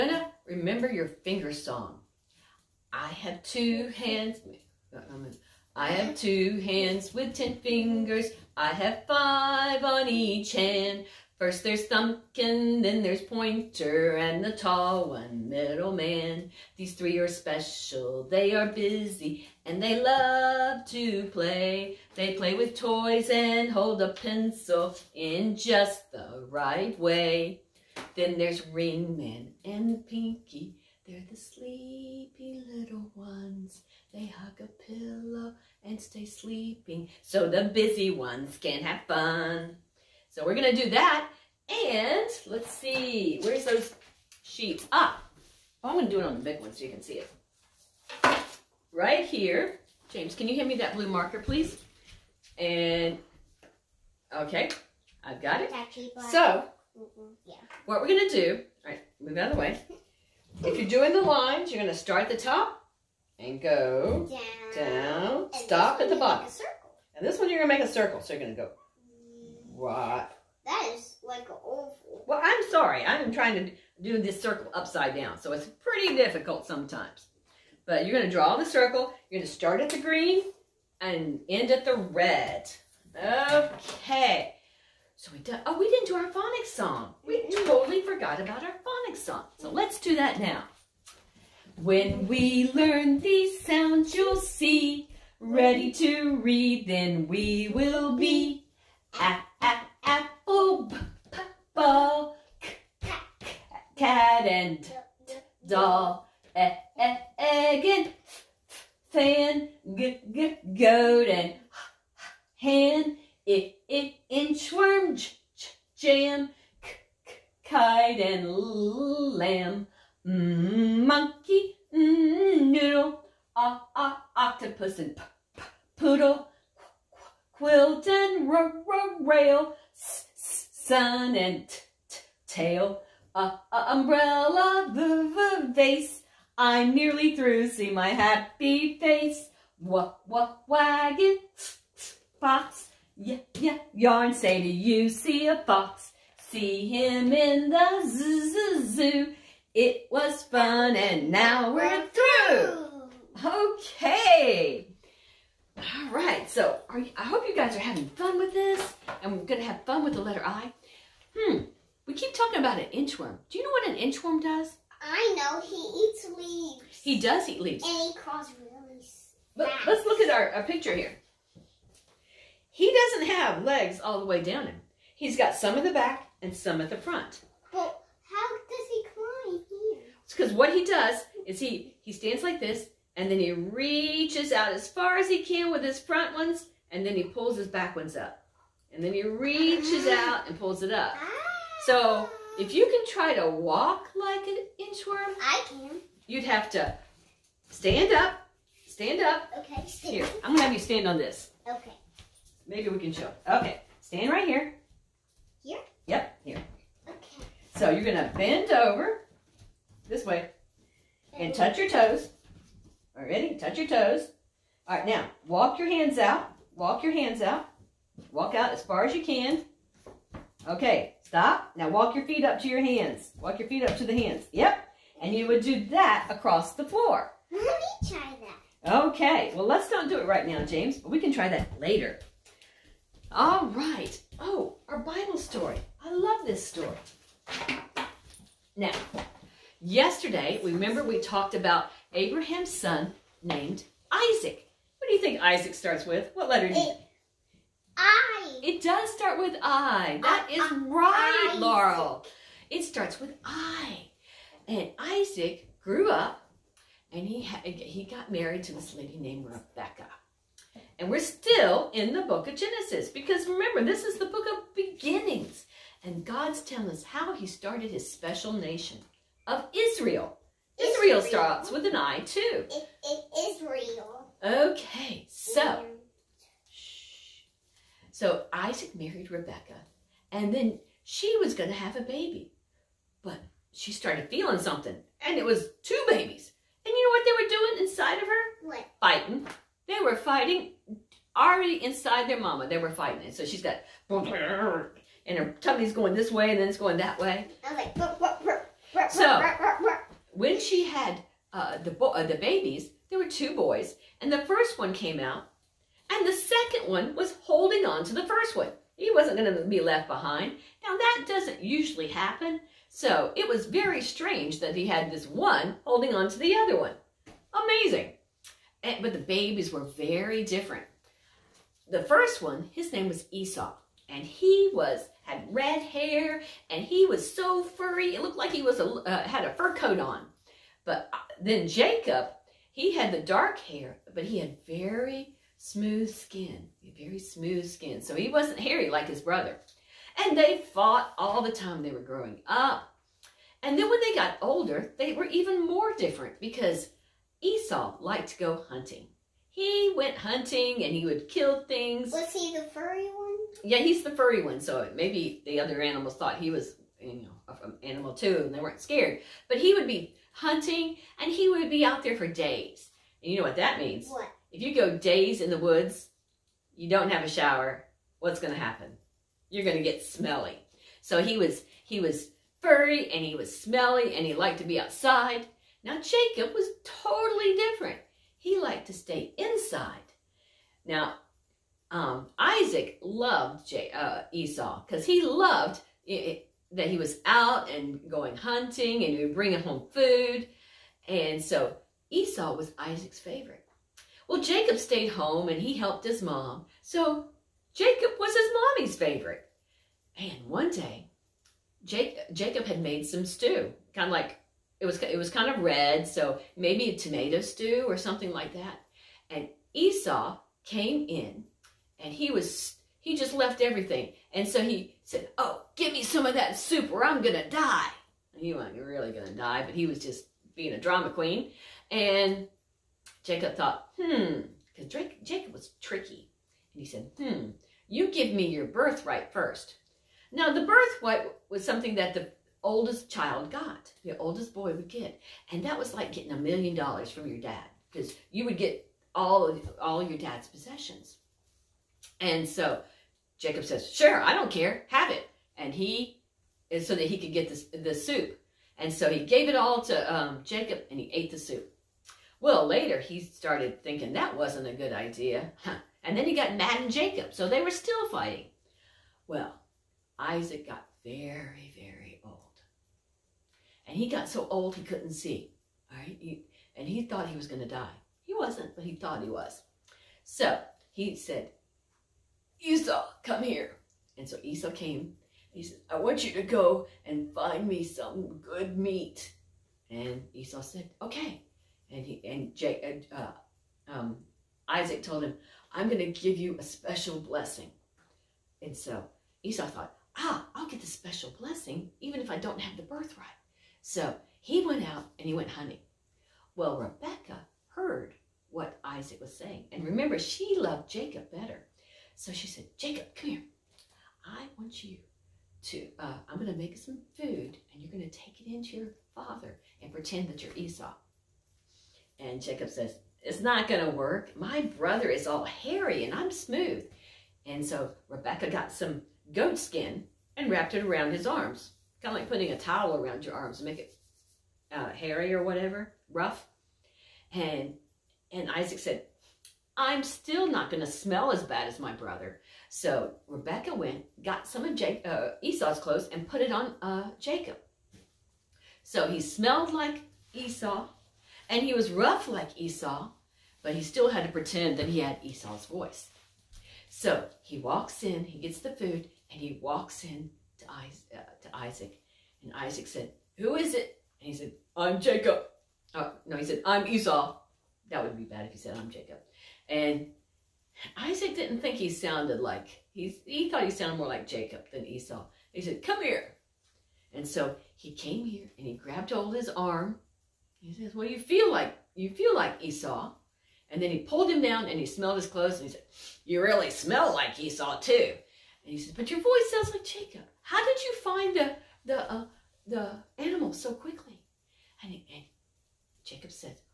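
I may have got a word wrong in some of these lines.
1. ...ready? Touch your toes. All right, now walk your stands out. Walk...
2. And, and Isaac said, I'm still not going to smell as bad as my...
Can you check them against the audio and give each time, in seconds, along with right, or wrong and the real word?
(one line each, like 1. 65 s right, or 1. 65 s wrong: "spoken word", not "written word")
1. 213 s wrong: "hands", not "stands"
2. 527 s right.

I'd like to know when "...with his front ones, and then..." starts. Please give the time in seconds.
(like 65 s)
185 s.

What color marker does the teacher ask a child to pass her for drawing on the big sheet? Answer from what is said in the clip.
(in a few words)
Blue.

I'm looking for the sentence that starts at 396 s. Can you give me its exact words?
So Jacob was his mommy's favorite.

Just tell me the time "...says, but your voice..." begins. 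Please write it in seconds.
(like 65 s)
578 s.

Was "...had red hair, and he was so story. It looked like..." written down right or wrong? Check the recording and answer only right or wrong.
wrong.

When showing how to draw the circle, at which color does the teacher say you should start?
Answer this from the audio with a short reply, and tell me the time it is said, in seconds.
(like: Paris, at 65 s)
Green, at 79 s.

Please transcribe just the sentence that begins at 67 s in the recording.
And this one you're going to make a circle.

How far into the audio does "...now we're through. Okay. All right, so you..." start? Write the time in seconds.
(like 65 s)
151 s.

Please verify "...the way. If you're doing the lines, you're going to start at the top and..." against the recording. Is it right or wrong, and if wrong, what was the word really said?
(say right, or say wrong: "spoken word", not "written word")
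right.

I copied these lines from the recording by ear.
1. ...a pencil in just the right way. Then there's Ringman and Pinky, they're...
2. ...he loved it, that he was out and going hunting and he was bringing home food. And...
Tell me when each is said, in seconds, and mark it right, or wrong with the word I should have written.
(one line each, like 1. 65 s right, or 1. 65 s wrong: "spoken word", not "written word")
1. 24 s right
2. 385 s right.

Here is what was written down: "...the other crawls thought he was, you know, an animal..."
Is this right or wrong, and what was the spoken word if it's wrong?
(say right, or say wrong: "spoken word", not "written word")
wrong: "animals", not "crawls".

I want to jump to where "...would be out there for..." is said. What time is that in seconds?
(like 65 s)
361 s.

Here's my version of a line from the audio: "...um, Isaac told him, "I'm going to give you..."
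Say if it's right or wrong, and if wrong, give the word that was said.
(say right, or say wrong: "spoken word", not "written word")
right.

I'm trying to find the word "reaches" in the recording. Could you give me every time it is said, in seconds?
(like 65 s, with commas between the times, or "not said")
183 s, 189 s.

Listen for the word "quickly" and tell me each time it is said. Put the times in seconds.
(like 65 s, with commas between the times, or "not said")
583 s.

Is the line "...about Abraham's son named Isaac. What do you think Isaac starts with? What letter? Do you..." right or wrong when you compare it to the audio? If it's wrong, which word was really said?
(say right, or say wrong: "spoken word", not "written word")
right.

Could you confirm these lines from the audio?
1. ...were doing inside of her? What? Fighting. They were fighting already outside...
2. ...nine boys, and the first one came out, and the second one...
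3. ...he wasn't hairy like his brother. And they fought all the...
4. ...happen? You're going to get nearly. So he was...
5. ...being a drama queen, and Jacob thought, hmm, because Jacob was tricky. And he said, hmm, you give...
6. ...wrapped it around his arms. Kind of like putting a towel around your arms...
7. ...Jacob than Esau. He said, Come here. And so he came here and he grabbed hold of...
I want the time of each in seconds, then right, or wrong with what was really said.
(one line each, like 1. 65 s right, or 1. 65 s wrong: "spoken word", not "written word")
1. 287 s wrong: "inside", not "outside"
2. 303 s wrong: "two", not "nine"
3. 338 s right
4. 368 s wrong: "smelly", not "nearly"
5. 420 s right
6. 520 s right
7. 564 s right.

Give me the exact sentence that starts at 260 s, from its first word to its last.
And we're still in the book of Genesis because remember, this is the book of beginnings.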